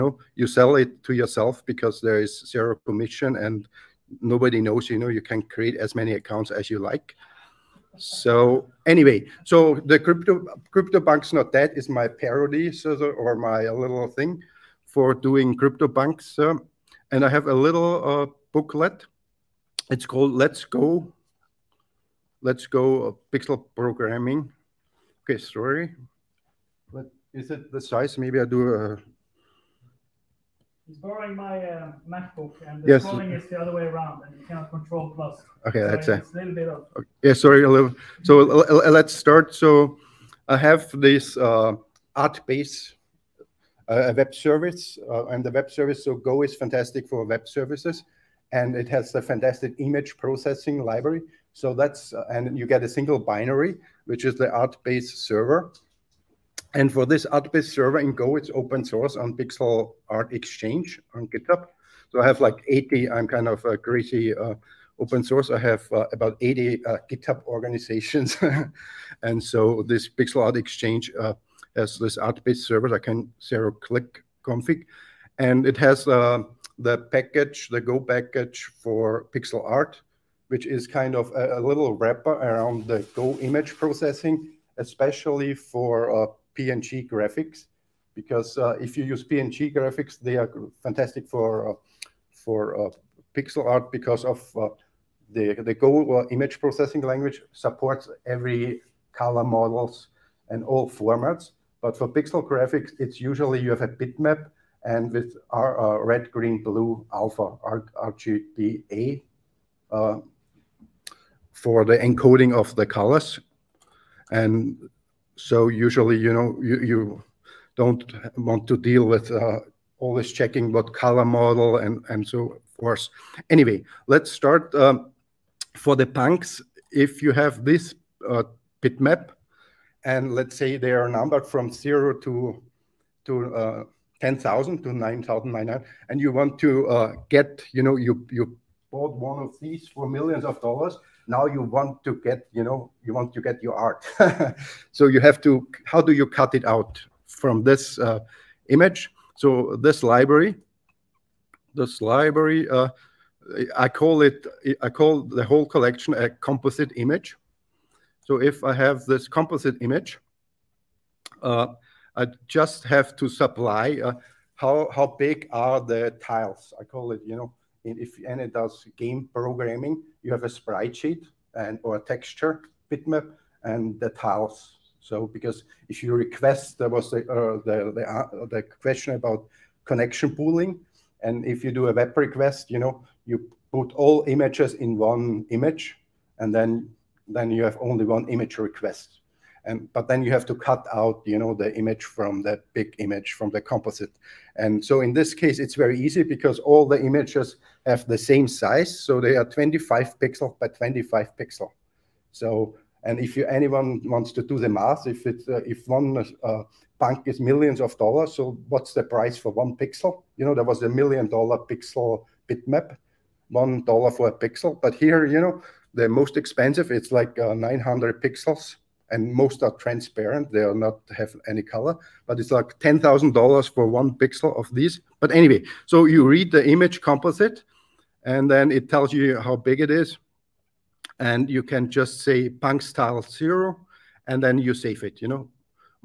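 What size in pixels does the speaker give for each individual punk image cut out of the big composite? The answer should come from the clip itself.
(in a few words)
25 by 25 pixels.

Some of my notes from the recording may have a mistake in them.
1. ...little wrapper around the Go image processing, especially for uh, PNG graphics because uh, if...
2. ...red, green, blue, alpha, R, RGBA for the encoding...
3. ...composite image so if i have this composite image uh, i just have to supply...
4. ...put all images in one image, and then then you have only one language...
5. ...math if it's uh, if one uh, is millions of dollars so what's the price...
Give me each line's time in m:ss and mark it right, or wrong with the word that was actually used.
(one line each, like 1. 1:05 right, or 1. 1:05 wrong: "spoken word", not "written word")
1. 1:21 right
2. 1:46 right
3. 2:36 right
4. 3:03 wrong: "image", not "language"
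5. 3:24 right.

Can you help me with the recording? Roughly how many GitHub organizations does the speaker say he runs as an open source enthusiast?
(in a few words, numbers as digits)
80.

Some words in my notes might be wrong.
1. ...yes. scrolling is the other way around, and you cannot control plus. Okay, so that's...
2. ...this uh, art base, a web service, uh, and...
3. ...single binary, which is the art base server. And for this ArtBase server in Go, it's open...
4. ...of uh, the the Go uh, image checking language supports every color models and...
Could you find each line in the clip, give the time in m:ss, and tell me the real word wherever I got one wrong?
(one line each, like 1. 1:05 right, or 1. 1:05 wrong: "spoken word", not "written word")
1. 0:32 right
2. 0:41 right
3. 0:52 right
4. 1:34 wrong: "processing", not "checking".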